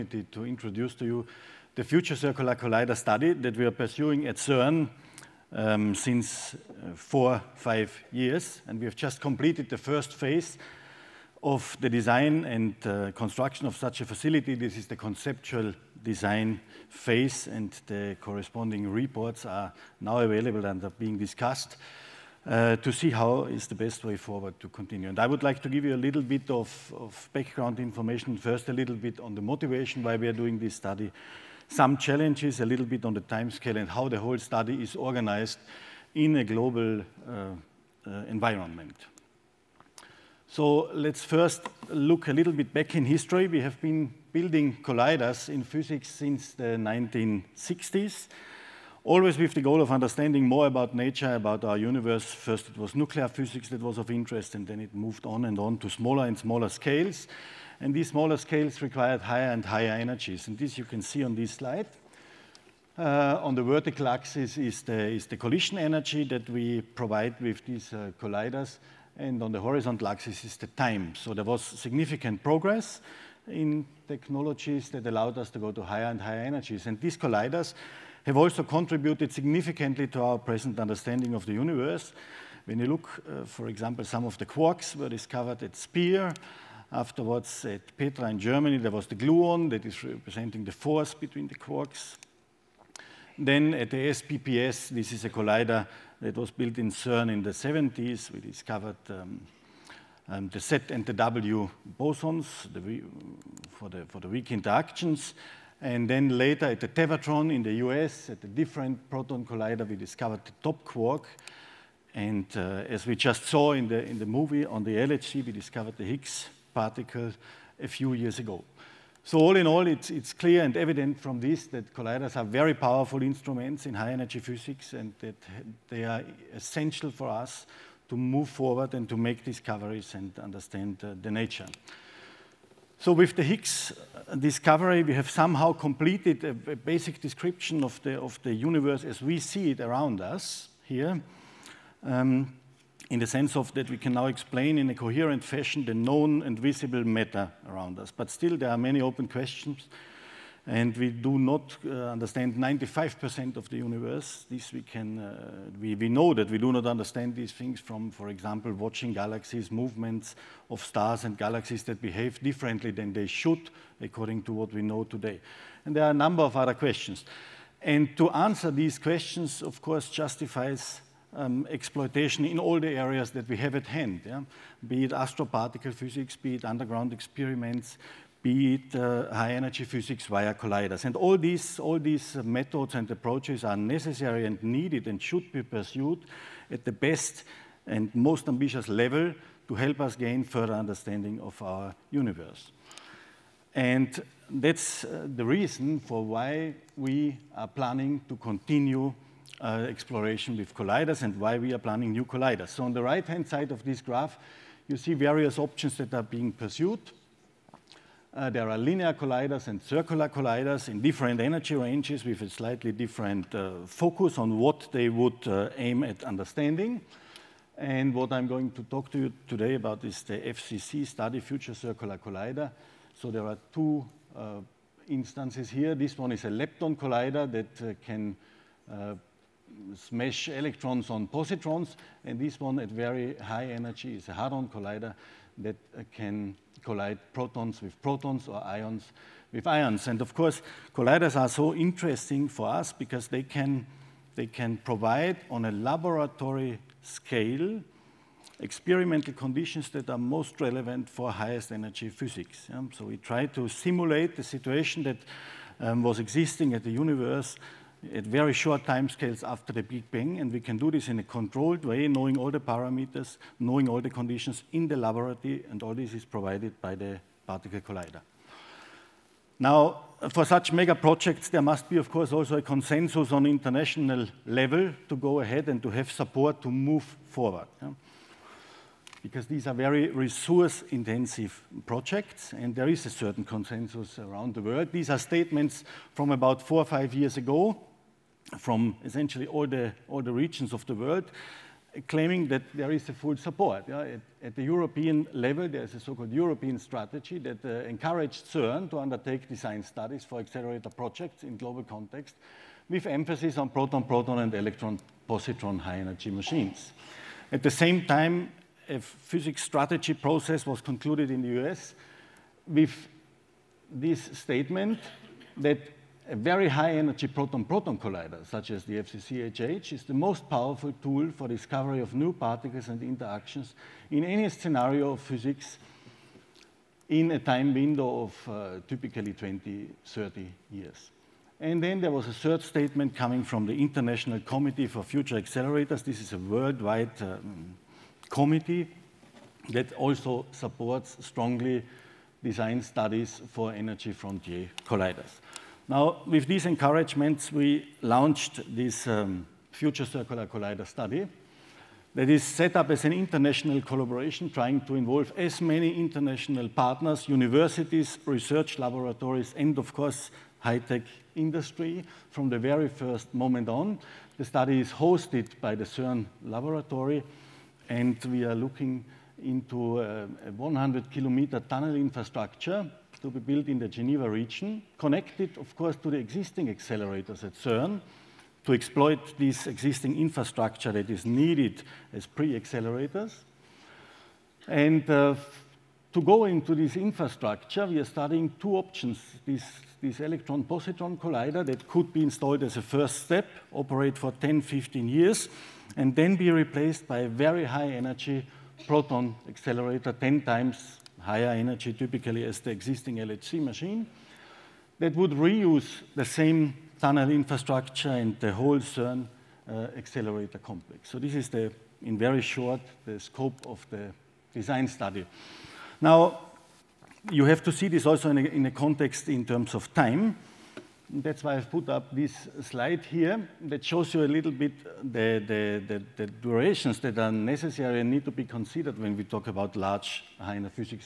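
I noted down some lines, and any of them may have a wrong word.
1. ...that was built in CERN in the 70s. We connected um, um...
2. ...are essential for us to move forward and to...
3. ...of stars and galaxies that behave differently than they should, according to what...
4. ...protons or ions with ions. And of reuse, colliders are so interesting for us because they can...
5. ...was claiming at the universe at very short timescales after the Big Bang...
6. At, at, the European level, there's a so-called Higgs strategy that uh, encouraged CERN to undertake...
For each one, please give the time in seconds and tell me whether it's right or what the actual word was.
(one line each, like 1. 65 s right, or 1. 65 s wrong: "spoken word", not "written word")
1. 96 s wrong: "discovered", not "connected"
2. 126 s right
3. 160 s right
4. 238 s wrong: "course", not "reuse"
5. 256 s wrong: "existing", not "claiming"
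6. 294 s wrong: "European", not "Higgs".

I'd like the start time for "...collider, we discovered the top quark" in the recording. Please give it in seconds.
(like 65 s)
109 s.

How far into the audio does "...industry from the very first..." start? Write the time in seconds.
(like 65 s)
361 s.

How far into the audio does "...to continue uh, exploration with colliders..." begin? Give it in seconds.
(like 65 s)
198 s.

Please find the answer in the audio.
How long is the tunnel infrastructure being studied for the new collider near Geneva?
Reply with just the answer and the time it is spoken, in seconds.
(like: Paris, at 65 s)
100 kilometers, at 370 s.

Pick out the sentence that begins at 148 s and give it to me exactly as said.
But still, there are many open questions and we do not uh, understand 95% of the universe.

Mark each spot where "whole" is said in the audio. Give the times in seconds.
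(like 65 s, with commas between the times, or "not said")
34 s, 408 s.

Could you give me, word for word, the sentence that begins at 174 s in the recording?
be it astroparticle physics, be it underground experiments, be it uh, high energy physics via colliders.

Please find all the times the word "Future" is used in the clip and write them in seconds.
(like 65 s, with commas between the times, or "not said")
1 s, 221 s, 335 s, 349 s.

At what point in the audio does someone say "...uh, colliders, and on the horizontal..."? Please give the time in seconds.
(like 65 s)
67 s.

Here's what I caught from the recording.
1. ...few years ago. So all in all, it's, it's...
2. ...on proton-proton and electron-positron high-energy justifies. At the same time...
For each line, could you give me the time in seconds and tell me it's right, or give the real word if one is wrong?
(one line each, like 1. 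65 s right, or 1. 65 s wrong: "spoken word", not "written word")
1. 117 s right
2. 303 s wrong: "machines", not "justifies".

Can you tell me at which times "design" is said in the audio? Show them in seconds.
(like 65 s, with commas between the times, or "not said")
11 s, 16 s, 299 s, 342 s, 414 s.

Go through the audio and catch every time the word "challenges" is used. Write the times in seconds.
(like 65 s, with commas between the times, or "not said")
31 s.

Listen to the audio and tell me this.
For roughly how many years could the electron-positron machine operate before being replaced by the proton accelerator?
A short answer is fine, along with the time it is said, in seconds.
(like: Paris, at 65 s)
10 to 15 years, at 394 s.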